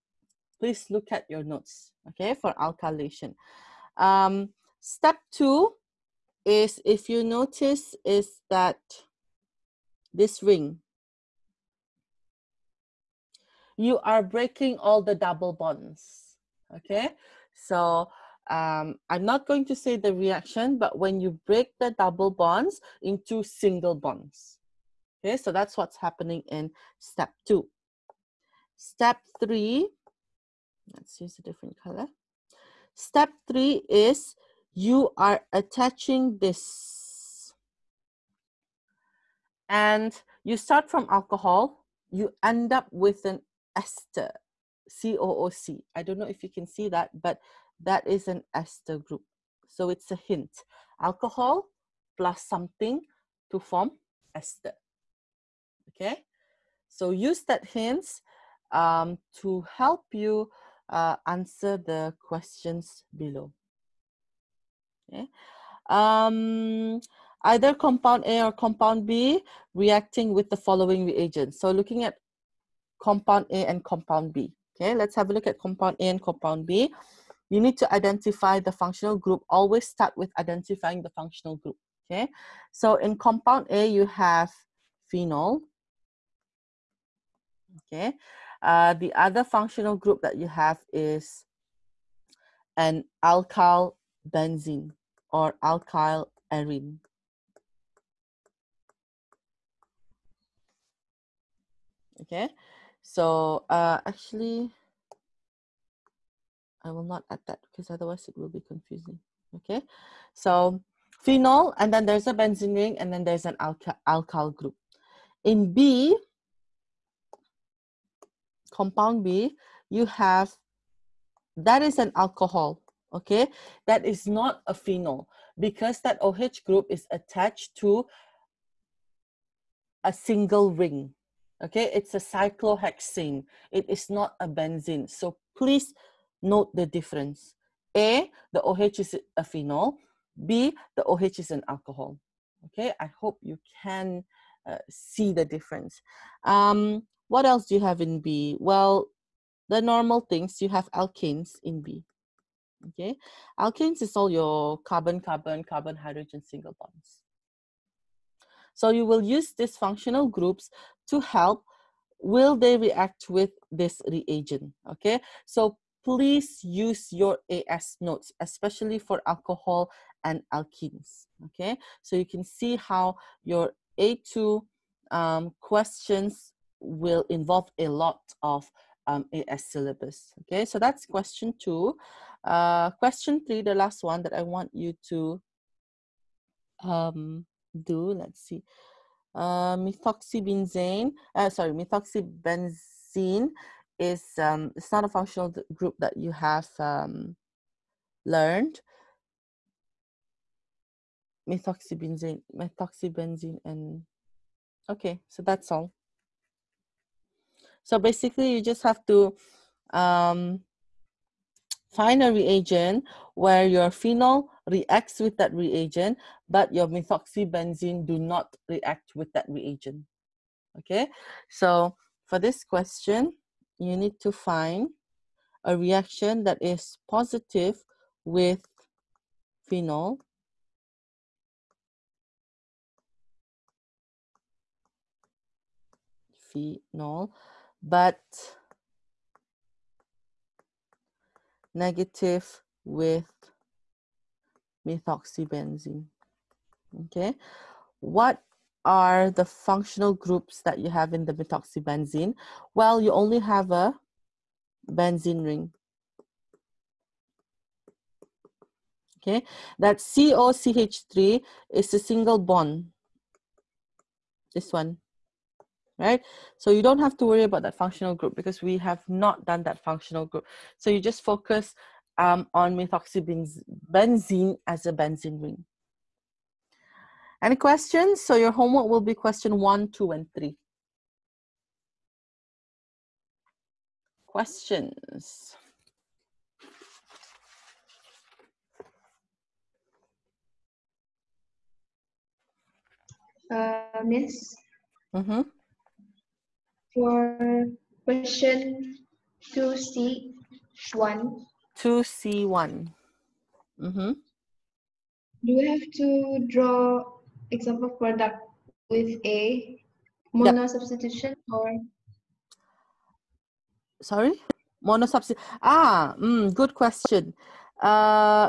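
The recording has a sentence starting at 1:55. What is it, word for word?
In B, compound B, you have, that is an alcohol, okay?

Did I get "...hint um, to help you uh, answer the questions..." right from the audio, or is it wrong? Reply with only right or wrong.
right.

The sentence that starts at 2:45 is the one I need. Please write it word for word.
So please use your AS notes, especially for alcohol and alkenes, okay?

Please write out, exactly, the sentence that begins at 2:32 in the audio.
Okay, alkanes is all your carbon, carbon, carbon, hydrogen single bonds.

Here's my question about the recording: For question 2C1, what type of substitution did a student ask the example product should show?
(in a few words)
Mono substitution.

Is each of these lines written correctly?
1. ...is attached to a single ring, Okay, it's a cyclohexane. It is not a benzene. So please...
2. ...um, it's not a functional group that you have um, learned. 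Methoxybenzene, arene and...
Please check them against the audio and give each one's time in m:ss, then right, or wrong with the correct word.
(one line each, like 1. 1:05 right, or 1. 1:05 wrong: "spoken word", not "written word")
1. 2:06 right
2. 3:14 wrong: "methoxybenzene", not "arene".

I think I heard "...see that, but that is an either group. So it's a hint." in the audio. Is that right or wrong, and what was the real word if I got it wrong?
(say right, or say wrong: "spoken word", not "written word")
wrong: "ester", not "either".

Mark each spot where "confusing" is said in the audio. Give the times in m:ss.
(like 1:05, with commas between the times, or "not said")
1:48.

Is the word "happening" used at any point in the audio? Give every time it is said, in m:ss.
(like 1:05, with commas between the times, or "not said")
0:25.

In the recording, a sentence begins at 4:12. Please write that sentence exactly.
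Well, you only have a benzene ring.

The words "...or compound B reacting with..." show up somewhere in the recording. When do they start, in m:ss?
1:08.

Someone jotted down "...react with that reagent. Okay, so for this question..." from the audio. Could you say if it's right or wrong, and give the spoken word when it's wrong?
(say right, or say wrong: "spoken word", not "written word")
right.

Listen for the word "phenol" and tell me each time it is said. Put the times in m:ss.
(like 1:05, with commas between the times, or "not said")
1:25, 1:51, 2:04, 2:19, 3:33, 3:49, 3:56.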